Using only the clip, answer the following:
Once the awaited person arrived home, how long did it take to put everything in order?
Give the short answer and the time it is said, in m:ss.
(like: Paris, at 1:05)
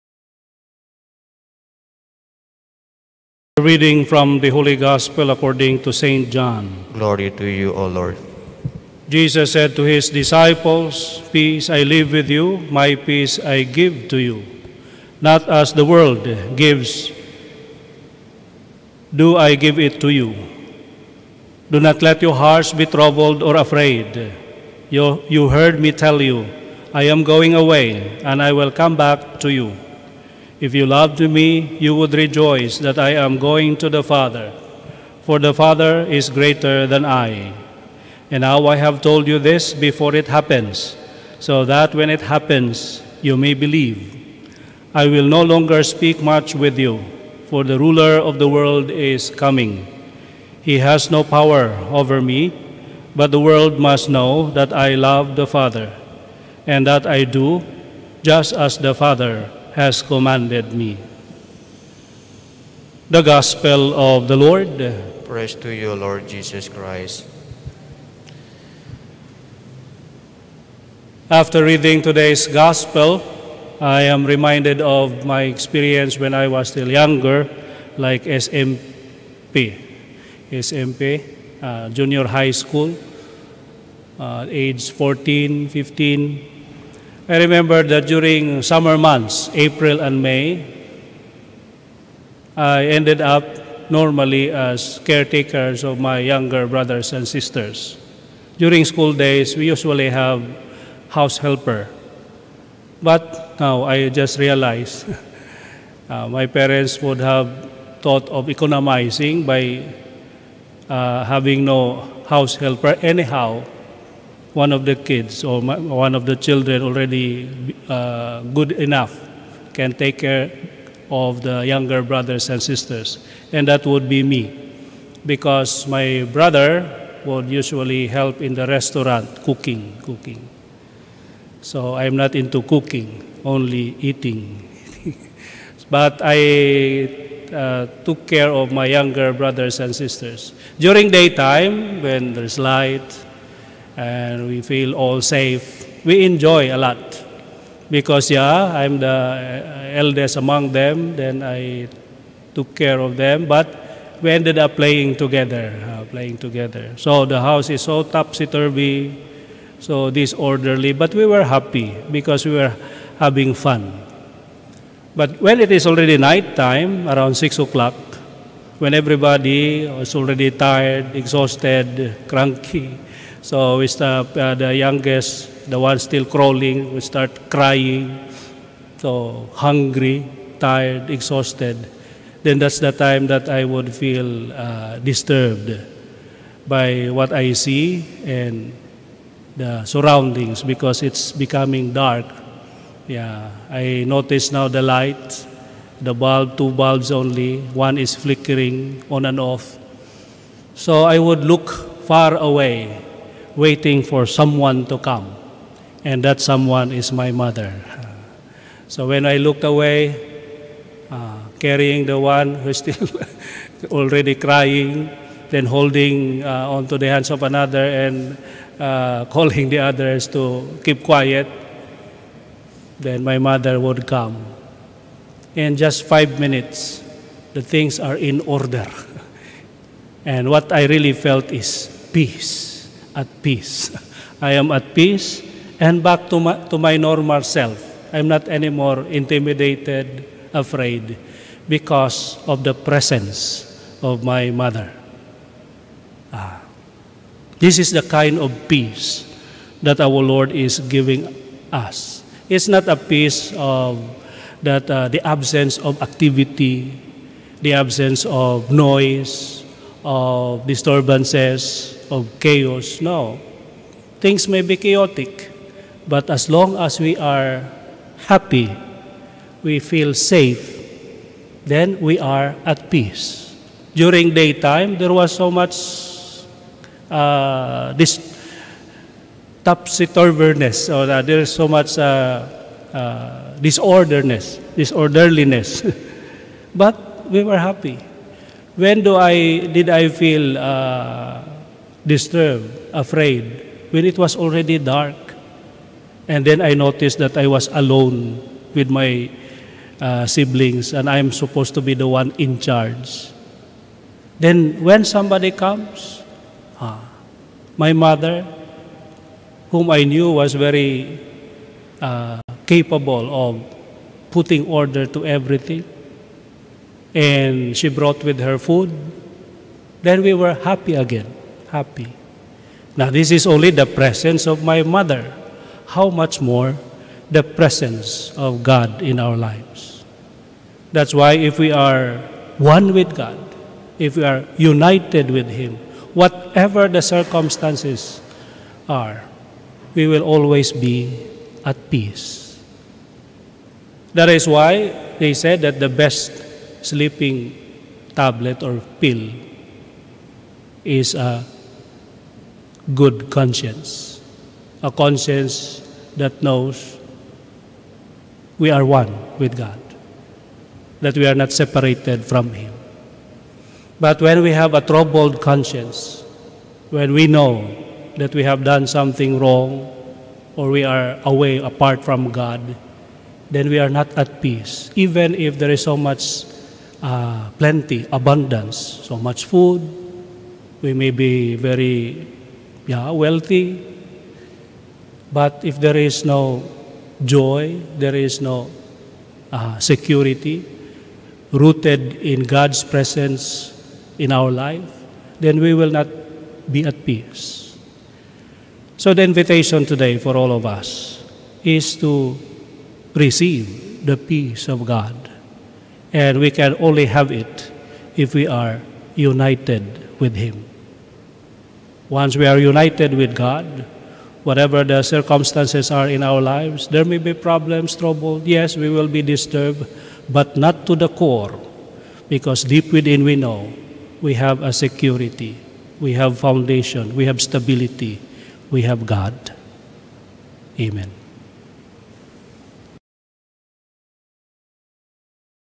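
5 minutes, at 3:46.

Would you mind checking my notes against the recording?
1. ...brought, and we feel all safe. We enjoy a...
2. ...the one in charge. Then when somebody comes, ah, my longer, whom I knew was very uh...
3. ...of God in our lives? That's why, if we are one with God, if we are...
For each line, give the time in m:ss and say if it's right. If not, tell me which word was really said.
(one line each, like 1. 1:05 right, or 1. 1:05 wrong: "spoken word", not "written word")
1. 2:22 wrong: "light", not "brought"
2. 5:01 wrong: "mother", not "longer"
3. 5:28 right.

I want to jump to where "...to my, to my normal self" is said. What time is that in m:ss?
3:56.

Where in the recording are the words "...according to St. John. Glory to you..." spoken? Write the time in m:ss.
0:05.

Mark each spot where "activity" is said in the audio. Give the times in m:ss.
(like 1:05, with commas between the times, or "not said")
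4:16.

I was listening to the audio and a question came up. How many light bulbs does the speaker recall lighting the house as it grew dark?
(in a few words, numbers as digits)
2.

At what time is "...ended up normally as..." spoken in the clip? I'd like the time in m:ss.
1:32.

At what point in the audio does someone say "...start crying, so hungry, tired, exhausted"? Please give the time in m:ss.
2:57.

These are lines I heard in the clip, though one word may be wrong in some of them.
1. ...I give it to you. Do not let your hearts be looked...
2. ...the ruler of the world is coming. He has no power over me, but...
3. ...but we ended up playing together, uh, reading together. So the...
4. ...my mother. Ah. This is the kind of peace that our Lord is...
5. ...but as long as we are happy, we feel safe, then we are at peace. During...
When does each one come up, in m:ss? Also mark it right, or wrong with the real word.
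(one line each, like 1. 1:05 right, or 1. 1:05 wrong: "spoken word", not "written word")
1. 0:19 wrong: "troubled", not "looked"
2. 0:47 right
3. 2:33 wrong: "playing", not "reading"
4. 4:04 right
5. 4:26 right.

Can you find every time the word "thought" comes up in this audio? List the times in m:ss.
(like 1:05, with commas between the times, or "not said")
1:48.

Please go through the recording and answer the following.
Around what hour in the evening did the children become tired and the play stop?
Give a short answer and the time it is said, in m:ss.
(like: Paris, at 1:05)
6 o'clock, at 2:47.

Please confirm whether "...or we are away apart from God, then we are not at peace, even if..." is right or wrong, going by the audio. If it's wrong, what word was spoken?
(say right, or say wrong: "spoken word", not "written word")
right.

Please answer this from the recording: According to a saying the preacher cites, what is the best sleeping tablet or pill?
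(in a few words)
A good conscience.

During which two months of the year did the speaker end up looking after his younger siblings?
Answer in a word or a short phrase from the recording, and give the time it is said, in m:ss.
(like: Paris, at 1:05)
April and May, at 1:29.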